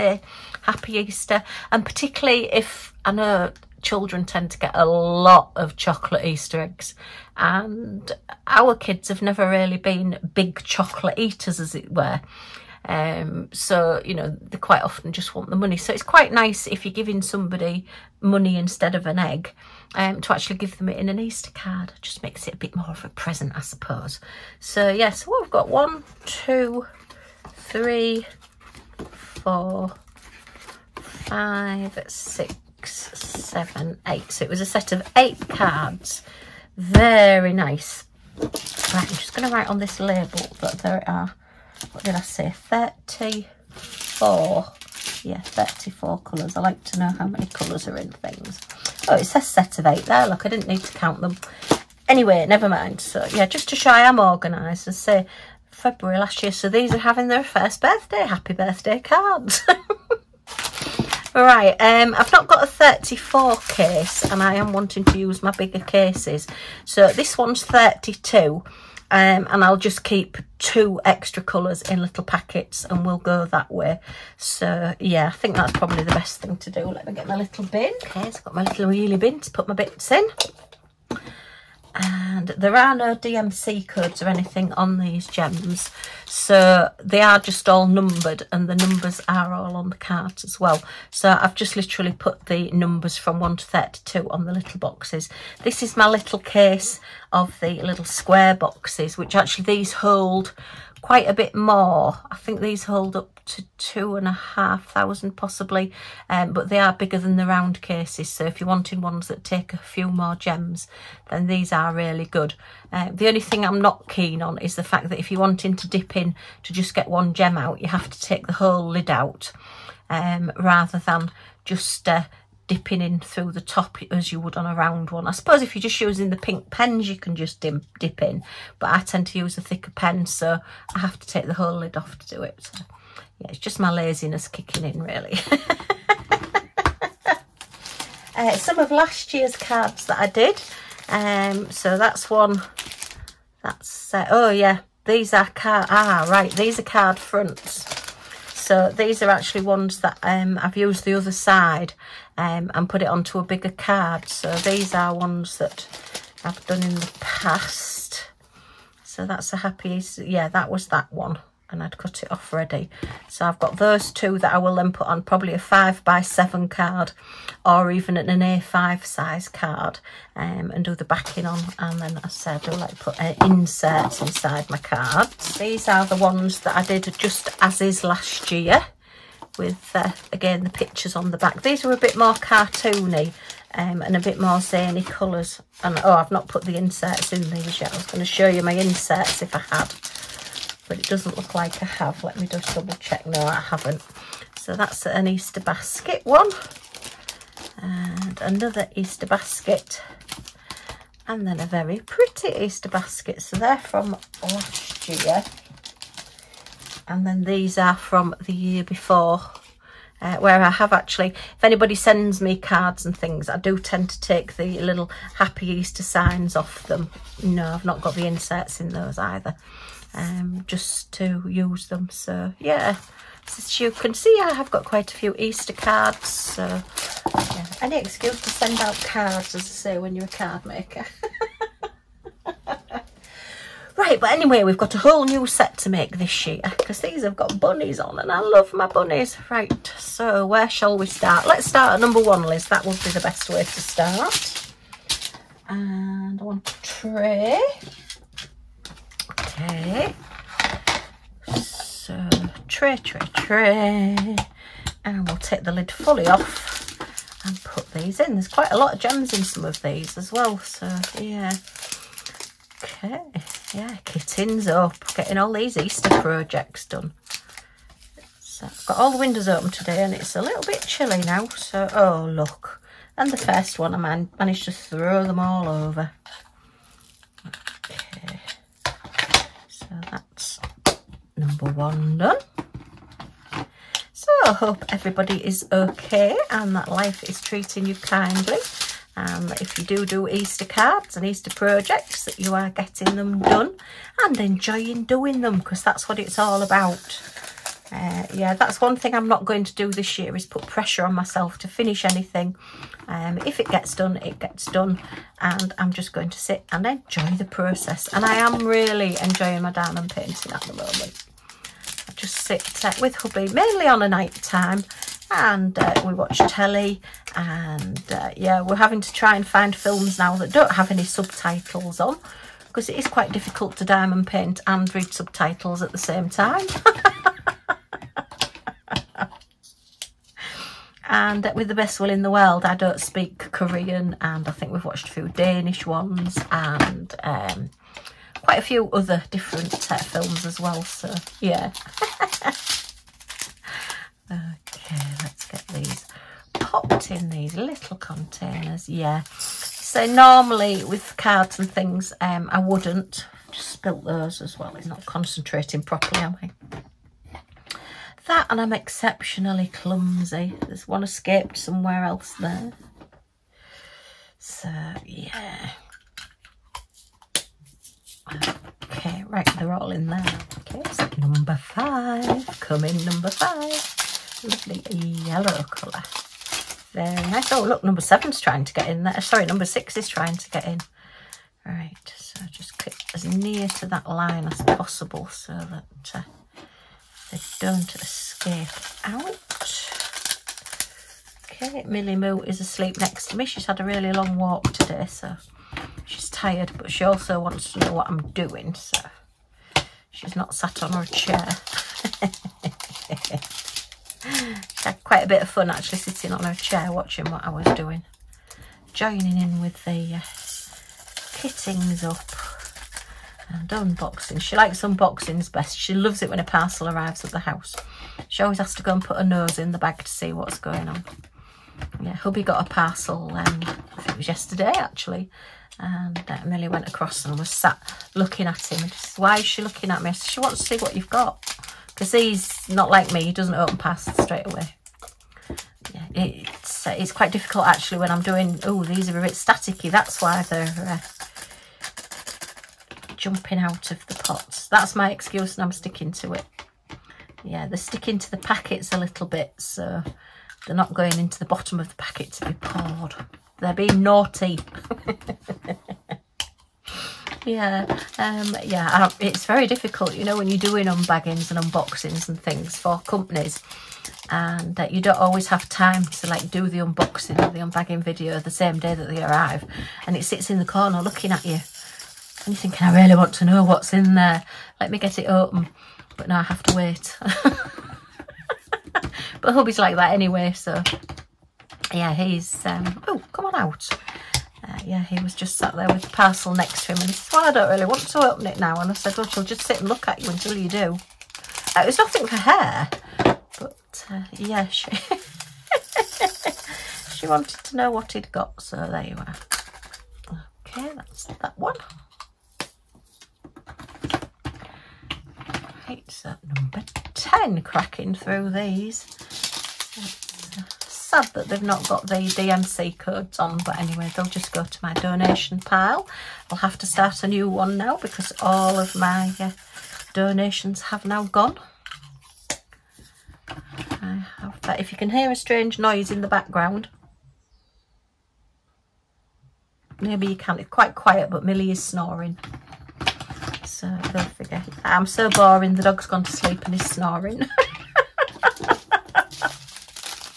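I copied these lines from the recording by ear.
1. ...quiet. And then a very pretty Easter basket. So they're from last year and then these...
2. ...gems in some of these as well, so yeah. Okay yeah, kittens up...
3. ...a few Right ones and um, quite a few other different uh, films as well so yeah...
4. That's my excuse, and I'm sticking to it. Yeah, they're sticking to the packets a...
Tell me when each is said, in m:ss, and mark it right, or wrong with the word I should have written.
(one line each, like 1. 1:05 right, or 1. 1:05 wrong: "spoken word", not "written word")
1. 3:19 wrong: "basket", not "quiet"
2. 4:19 right
3. 5:35 wrong: "Danish", not "Right"
4. 7:24 right.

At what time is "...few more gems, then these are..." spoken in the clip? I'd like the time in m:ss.
1:49.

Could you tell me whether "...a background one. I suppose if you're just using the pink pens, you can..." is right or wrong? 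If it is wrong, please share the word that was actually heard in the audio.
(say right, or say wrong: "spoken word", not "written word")
wrong: "round", not "background".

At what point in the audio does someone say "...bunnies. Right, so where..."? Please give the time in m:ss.
3:58.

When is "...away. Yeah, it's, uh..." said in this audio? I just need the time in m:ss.
7:14.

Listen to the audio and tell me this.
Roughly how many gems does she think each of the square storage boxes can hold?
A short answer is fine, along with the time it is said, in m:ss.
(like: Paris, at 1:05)
2,500, at 1:43.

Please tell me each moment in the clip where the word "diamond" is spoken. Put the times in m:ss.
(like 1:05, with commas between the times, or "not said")
5:09, 5:23.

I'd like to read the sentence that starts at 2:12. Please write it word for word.
So, yeah, it's just my laziness kicking in, really.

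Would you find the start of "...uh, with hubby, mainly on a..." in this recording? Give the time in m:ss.
5:12.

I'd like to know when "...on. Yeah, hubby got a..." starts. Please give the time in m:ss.
7:00.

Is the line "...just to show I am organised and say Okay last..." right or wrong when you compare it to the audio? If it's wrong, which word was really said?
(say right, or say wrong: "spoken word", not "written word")
wrong: "February", not "Okay".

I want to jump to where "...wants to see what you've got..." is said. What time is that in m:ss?
7:10.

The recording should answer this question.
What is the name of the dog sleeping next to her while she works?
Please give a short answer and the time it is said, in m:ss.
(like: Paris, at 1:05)
Millie Moo, at 6:31.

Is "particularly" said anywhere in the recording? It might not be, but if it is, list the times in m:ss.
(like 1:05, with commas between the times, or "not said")
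0:01.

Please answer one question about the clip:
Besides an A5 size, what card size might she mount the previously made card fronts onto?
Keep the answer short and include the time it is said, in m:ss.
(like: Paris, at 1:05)
5 by 7, at 2:45.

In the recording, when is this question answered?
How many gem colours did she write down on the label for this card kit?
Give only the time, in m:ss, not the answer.
0:45.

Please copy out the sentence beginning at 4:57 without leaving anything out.
Uh, yeah, that's one thing I'm not going to do this year is put pressure on myself to finish anything.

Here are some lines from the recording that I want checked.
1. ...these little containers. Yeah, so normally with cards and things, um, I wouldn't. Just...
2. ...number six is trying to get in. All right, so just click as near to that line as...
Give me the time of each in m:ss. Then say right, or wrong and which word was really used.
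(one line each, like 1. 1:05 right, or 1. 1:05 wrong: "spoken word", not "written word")
1. 5:47 right
2. 6:19 right.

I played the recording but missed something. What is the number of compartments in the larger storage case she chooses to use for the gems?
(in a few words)
32.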